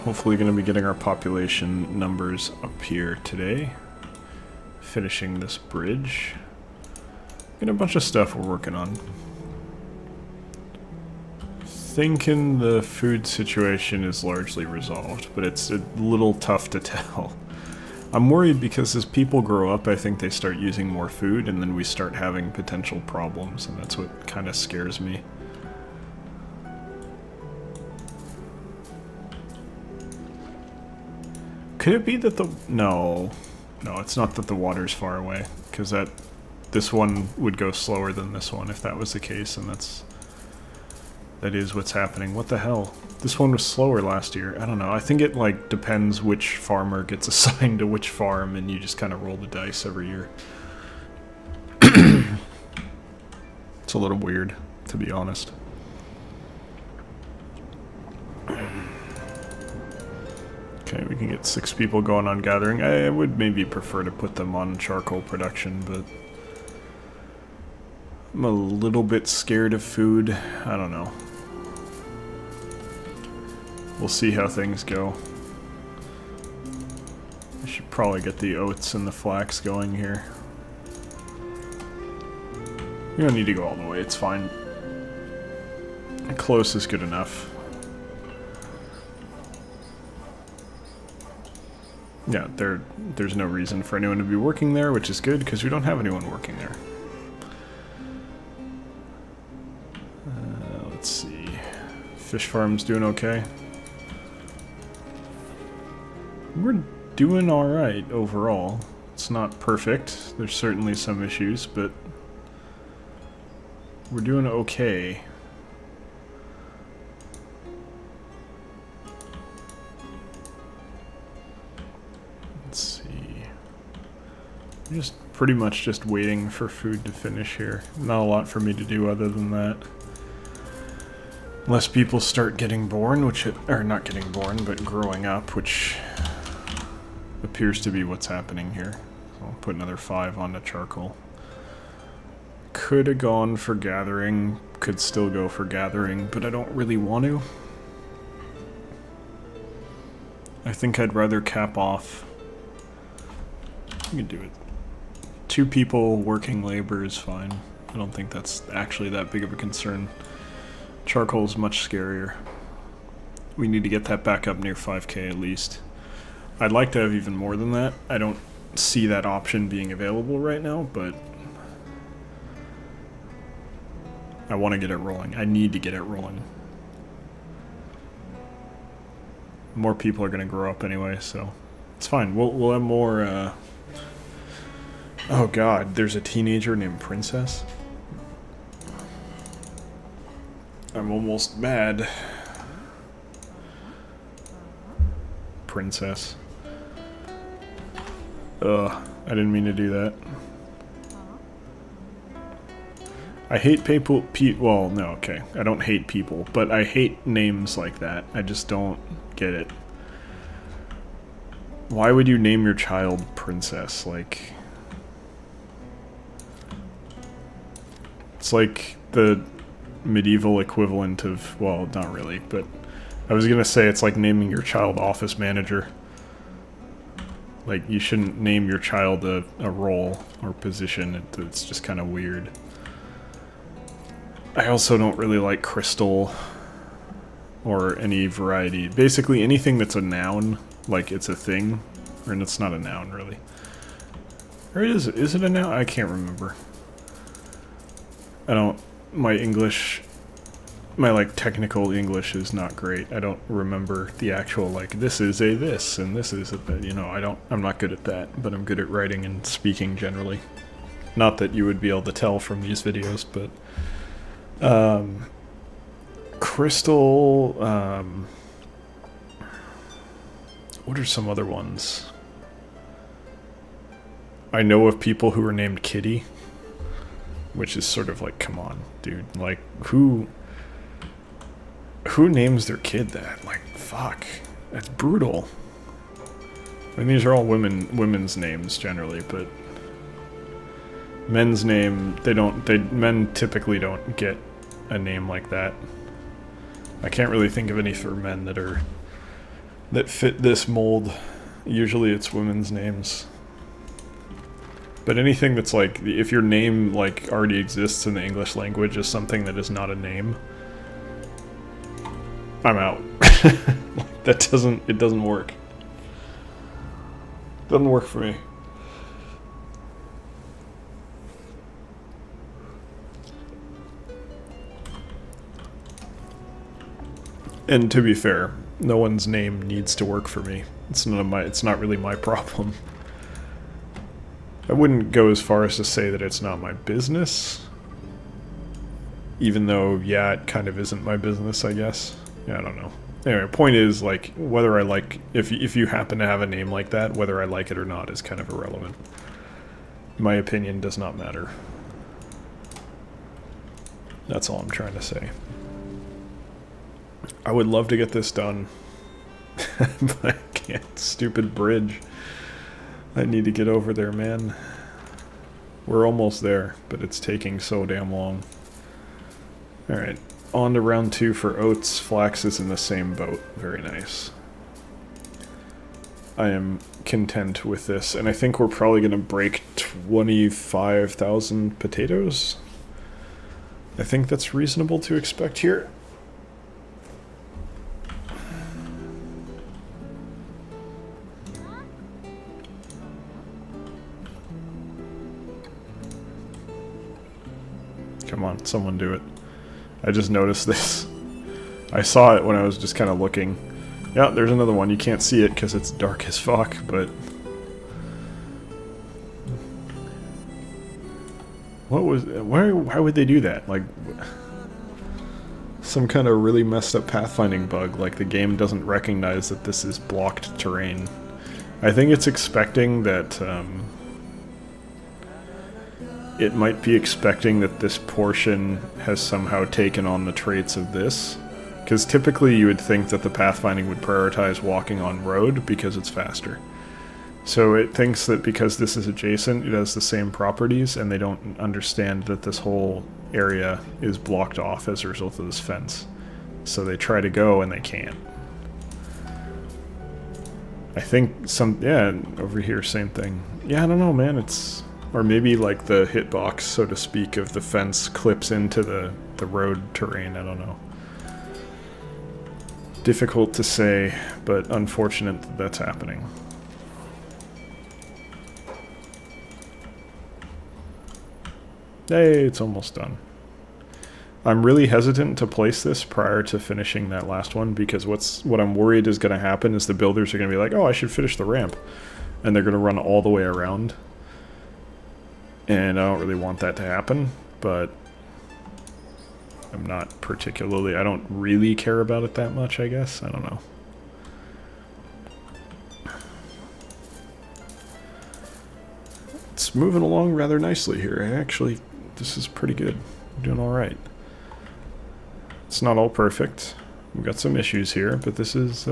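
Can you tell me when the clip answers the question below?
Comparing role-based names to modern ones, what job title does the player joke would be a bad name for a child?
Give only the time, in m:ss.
3:44.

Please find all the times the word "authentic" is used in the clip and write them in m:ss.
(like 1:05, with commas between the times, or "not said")
not said.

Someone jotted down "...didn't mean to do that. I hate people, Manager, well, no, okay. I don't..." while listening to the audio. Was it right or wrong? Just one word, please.
wrong.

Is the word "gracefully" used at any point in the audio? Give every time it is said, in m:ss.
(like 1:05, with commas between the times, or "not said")
not said.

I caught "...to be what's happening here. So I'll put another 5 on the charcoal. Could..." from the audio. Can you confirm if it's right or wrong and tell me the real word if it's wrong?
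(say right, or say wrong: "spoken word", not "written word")
right.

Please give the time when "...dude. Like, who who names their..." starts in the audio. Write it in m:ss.
4:39.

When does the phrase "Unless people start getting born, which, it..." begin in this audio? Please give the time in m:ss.
2:11.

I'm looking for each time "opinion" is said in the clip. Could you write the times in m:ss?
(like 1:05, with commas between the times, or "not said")
5:50.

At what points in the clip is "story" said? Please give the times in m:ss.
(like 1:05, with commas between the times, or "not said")
not said.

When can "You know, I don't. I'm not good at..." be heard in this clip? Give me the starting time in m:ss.
4:16.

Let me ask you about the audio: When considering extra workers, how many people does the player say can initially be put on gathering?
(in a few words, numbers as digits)
6.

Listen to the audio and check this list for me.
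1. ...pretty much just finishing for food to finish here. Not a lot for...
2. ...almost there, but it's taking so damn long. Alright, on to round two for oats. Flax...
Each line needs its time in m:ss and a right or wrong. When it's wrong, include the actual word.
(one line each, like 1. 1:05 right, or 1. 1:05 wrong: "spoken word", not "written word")
1. 2:05 wrong: "waiting", not "finishing"
2. 6:06 right.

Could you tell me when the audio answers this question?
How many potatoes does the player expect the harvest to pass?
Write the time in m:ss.
6:19.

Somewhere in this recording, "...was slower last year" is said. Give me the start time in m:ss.
0:43.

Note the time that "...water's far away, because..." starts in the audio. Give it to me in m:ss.
0:34.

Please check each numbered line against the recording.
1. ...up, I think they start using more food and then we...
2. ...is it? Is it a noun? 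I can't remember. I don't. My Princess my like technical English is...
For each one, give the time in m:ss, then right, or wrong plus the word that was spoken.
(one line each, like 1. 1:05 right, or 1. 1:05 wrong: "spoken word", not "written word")
1. 0:19 right
2. 4:04 wrong: "English", not "Princess".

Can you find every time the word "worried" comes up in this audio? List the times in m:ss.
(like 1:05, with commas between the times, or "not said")
0:18, 7:58.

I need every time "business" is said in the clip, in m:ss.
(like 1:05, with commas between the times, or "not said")
5:36, 5:41.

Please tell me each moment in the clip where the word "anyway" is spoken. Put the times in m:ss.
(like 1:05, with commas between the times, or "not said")
3:00, 5:43.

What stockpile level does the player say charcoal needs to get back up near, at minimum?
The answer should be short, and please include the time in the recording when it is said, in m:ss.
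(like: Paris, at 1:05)
5k, at 2:44.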